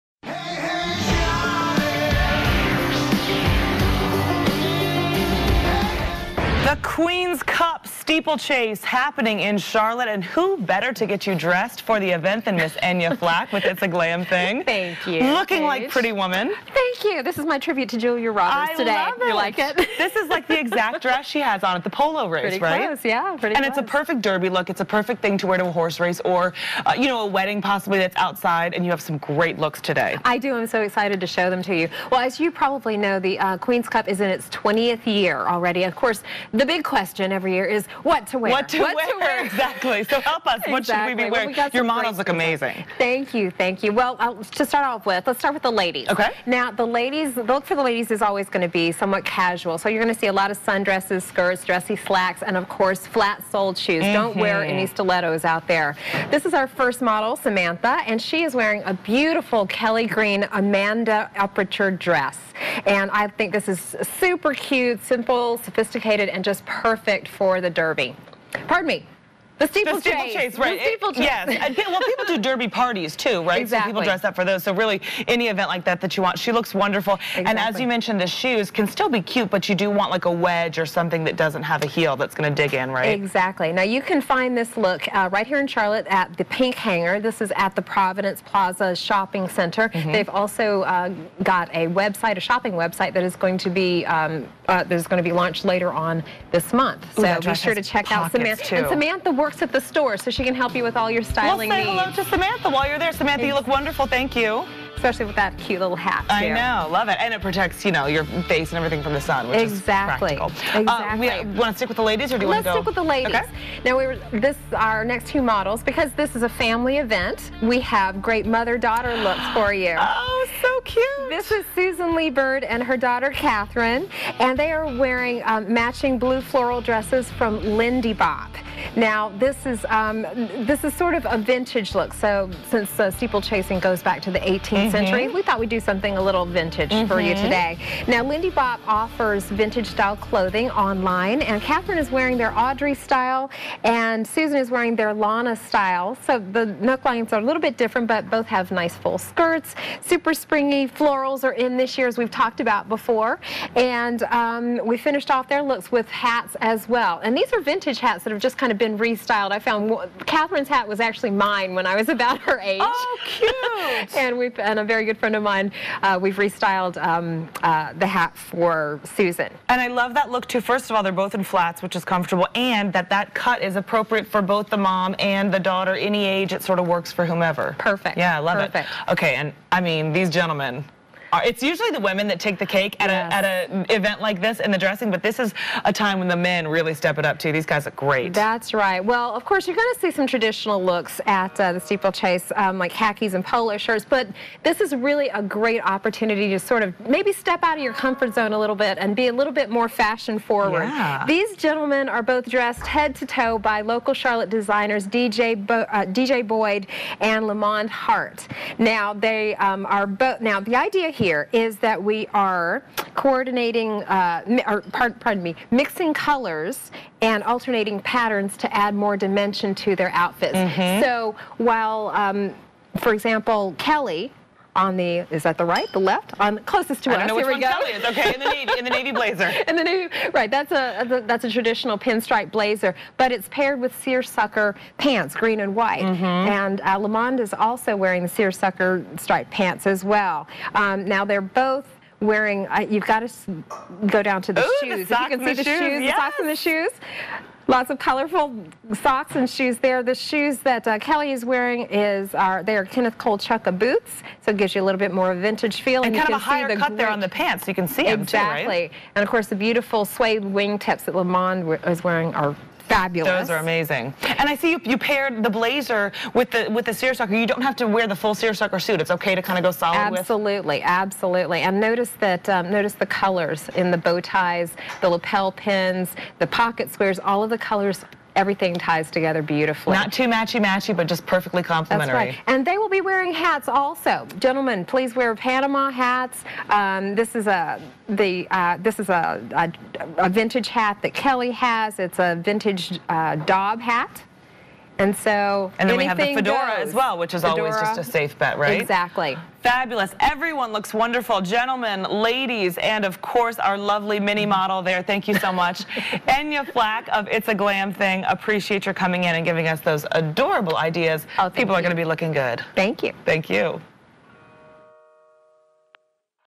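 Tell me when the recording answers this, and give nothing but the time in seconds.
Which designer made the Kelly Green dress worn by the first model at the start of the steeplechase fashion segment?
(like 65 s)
60 s.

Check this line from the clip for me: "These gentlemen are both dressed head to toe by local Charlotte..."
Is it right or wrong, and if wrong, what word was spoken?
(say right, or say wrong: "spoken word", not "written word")
right.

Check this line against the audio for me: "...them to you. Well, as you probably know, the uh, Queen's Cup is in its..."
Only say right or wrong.
right.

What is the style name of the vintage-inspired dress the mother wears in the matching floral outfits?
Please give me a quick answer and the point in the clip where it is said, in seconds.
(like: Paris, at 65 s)
Lana, at 145 s.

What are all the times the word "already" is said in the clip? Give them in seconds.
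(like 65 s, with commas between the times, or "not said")
35 s.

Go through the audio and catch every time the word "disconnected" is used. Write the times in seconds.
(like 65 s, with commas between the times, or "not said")
not said.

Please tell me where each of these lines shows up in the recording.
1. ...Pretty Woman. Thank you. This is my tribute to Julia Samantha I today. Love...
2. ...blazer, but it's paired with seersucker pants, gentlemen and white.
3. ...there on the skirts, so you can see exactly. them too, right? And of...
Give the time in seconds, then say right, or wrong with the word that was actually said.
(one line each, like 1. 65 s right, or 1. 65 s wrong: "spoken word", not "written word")
1. 15 s wrong: "Roberts", not "Samantha"
2. 232 s wrong: "green", not "gentlemen"
3. 256 s wrong: "pants", not "skirts".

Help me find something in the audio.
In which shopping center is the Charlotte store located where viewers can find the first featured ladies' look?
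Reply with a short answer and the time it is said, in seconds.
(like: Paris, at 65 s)
Providence Plaza, at 87 s.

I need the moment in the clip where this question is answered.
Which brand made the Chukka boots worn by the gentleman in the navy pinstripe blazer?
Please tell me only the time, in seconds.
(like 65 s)
252 s.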